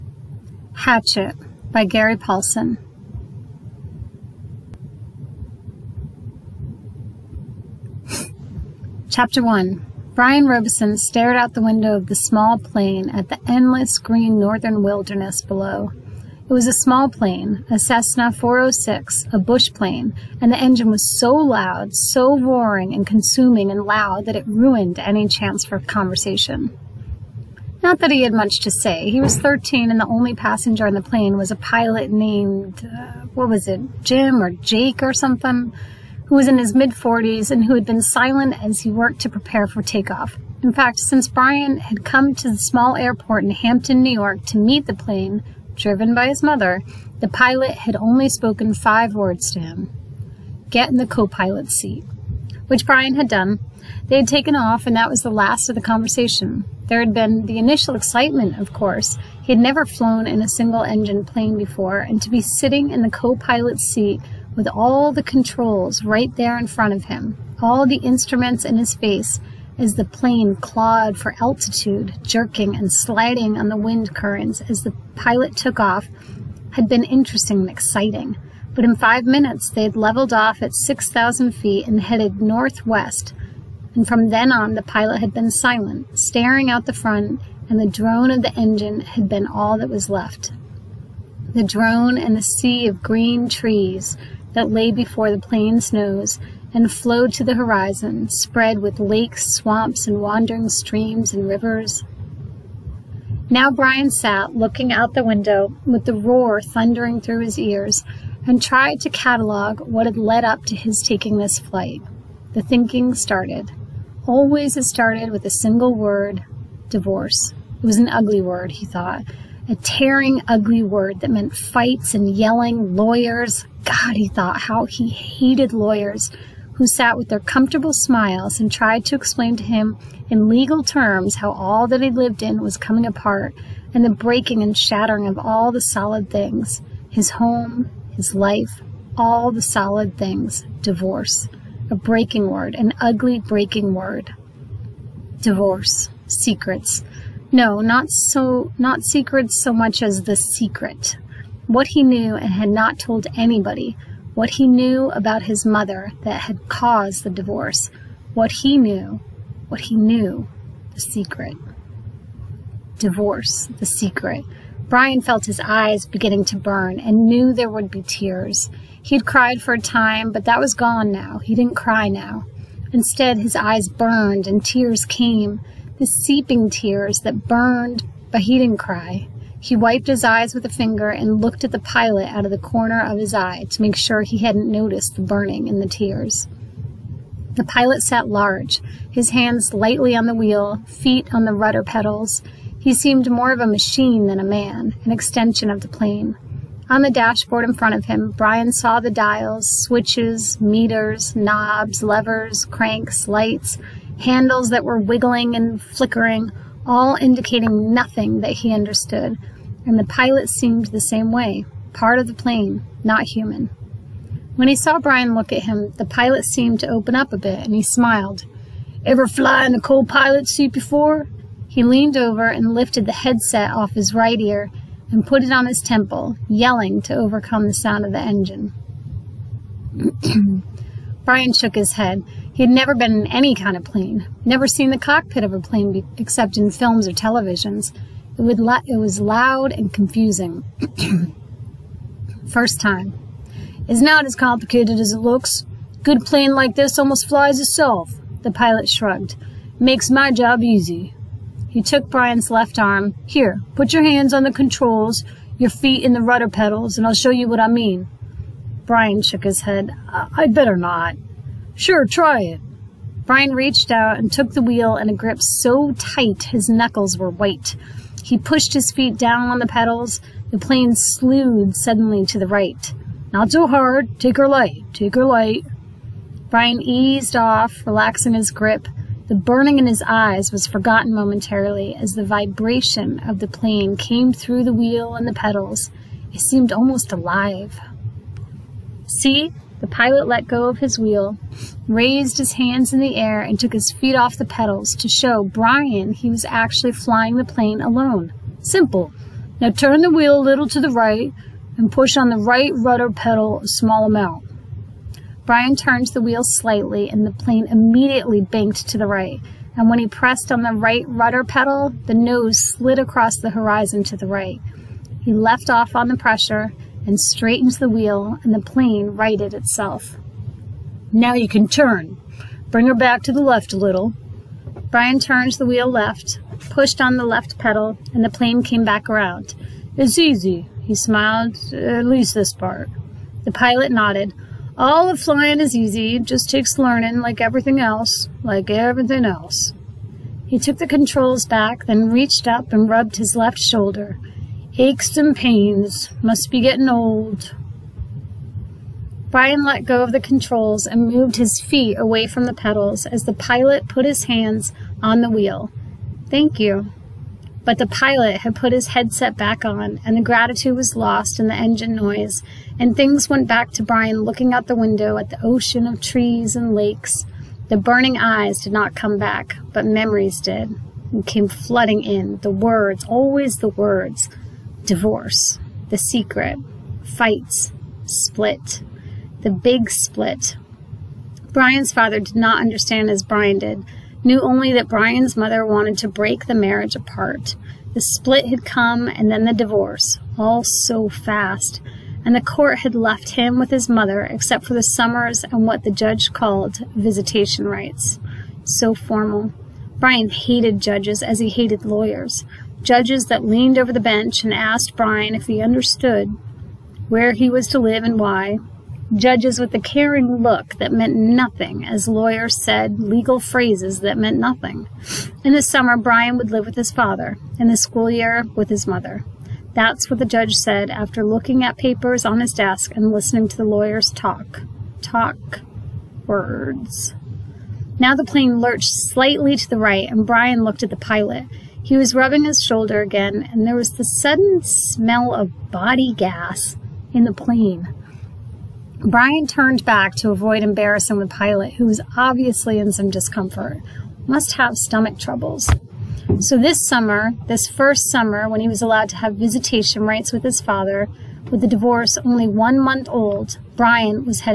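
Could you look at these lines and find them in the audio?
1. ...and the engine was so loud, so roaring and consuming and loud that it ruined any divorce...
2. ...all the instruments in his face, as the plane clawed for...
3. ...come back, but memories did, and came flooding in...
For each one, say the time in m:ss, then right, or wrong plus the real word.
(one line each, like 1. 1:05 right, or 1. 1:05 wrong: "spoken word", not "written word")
1. 0:20 wrong: "chance", not "divorce"
2. 1:07 right
3. 6:08 right.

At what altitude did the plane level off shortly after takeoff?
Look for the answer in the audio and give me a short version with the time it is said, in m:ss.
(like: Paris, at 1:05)
6,000 feet, at 1:20.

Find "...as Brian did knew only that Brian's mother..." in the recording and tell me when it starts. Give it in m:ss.
6:23.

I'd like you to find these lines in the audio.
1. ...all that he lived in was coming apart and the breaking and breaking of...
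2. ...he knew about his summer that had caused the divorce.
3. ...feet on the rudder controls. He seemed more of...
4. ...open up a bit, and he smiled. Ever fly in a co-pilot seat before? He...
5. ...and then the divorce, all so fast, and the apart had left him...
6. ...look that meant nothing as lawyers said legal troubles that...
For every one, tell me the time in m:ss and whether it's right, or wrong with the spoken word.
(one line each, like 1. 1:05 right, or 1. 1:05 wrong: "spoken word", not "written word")
1. 2:11 wrong: "shattering", not "breaking"
2. 2:34 wrong: "mother", not "summer"
3. 3:10 wrong: "pedals", not "controls"
4. 3:36 right
5. 6:29 wrong: "court", not "apart"
6. 6:50 wrong: "phrases", not "troubles".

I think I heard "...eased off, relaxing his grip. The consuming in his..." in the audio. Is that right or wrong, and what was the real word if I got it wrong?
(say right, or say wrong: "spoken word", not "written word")
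wrong: "burning", not "consuming".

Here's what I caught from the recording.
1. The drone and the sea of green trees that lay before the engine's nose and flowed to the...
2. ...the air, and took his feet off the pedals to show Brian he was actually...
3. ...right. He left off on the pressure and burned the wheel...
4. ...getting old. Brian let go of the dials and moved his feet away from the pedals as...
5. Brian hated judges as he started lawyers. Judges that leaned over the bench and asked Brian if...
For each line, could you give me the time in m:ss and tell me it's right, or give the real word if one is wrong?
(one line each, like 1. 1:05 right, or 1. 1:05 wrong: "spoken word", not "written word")
1. 1:31 wrong: "plane", not "engine"
2. 4:52 right
3. 5:14 wrong: "straightened", not "burned"
4. 5:46 wrong: "controls", not "dials"
5. 6:39 wrong: "hated", not "started".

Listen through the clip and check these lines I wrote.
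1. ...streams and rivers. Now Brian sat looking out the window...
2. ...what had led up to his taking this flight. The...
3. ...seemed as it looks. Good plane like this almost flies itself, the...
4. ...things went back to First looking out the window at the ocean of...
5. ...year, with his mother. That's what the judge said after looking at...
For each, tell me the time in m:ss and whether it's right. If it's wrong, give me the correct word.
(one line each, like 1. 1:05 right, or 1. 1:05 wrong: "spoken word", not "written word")
1. 1:40 right
2. 1:49 right
3. 4:04 wrong: "complicated", not "seemed"
4. 6:02 wrong: "Brian", not "First"
5. 6:58 right.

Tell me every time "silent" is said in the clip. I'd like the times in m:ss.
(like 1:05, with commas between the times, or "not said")
0:38, 1:25.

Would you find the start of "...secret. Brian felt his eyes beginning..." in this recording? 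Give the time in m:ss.
2:43.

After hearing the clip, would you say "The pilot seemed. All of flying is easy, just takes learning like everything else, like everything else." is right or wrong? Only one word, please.
wrong.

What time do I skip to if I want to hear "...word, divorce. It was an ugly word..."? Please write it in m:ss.
1:55.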